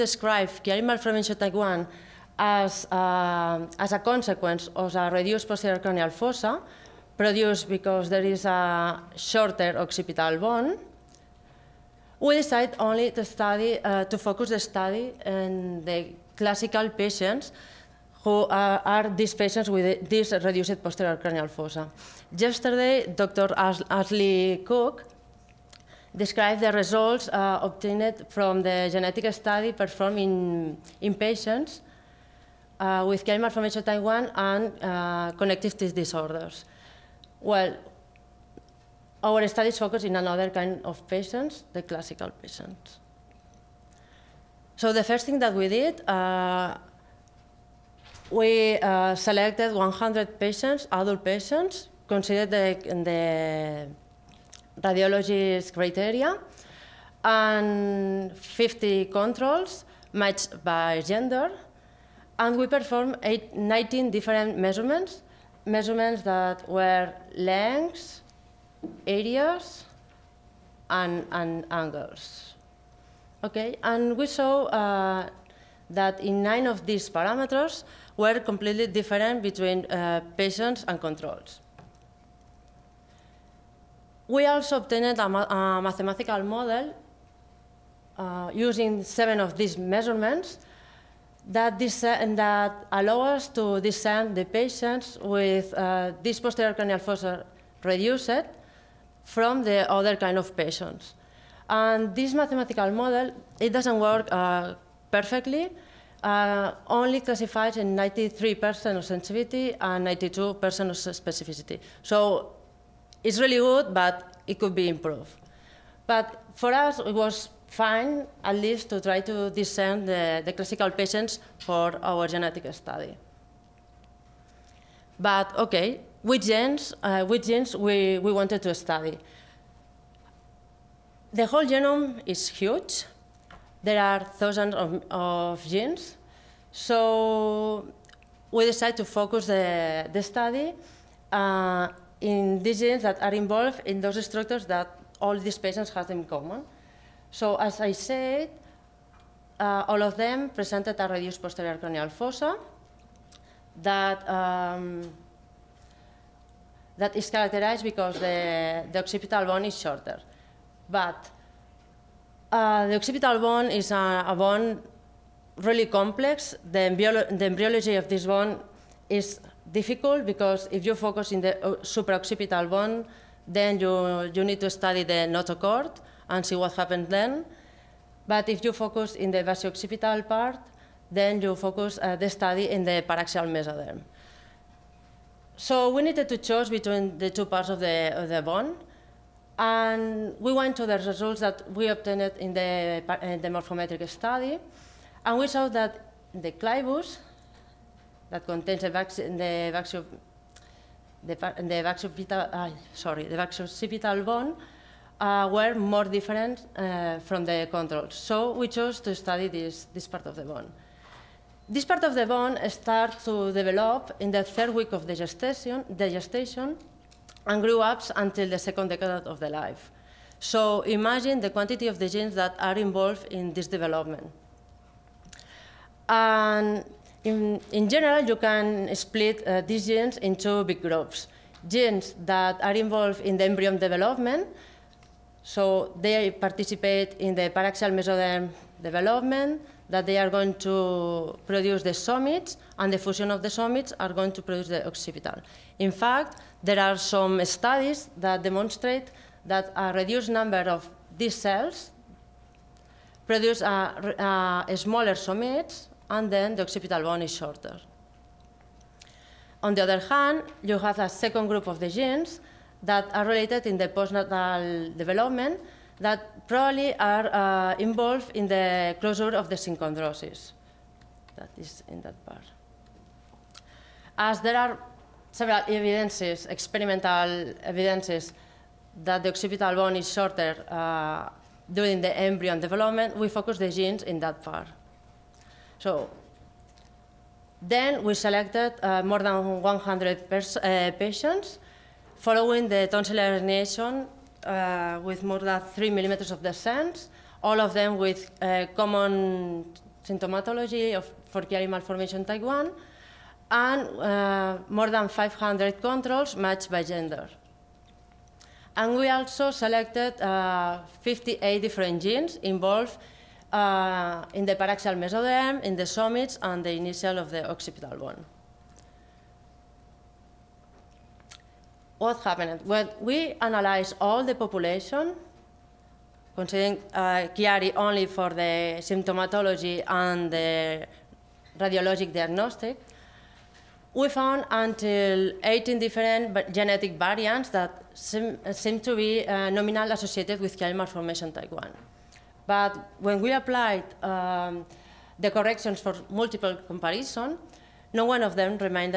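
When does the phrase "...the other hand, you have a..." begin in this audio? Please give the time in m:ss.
4:19.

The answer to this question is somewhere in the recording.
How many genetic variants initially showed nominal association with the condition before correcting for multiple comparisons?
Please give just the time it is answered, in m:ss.
5:35.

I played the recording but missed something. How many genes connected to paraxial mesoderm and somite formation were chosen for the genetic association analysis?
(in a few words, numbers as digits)
58.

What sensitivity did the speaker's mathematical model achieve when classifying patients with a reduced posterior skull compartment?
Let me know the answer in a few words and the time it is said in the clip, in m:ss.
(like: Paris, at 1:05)
93%, at 1:47.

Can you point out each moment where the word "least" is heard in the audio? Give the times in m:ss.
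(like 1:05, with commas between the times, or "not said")
1:58.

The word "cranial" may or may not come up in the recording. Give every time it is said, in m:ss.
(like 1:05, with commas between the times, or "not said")
0:05, 0:21, 1:36, 2:31.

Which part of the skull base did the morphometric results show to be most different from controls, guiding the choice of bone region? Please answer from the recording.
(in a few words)
the clivus.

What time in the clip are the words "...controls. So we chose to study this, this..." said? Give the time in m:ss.
3:27.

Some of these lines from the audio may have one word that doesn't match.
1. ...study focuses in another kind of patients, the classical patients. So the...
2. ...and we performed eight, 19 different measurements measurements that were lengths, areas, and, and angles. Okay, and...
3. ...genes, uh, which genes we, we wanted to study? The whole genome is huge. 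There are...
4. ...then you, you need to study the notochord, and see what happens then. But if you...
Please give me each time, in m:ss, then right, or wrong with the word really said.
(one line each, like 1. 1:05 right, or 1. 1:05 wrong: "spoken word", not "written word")
1. 0:39 right
2. 1:02 right
3. 2:06 right
4. 2:53 right.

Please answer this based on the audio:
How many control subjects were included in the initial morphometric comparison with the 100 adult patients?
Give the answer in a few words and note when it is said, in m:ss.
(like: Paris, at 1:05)
50, at 0:58.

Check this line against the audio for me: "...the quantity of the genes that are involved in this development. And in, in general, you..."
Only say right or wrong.
right.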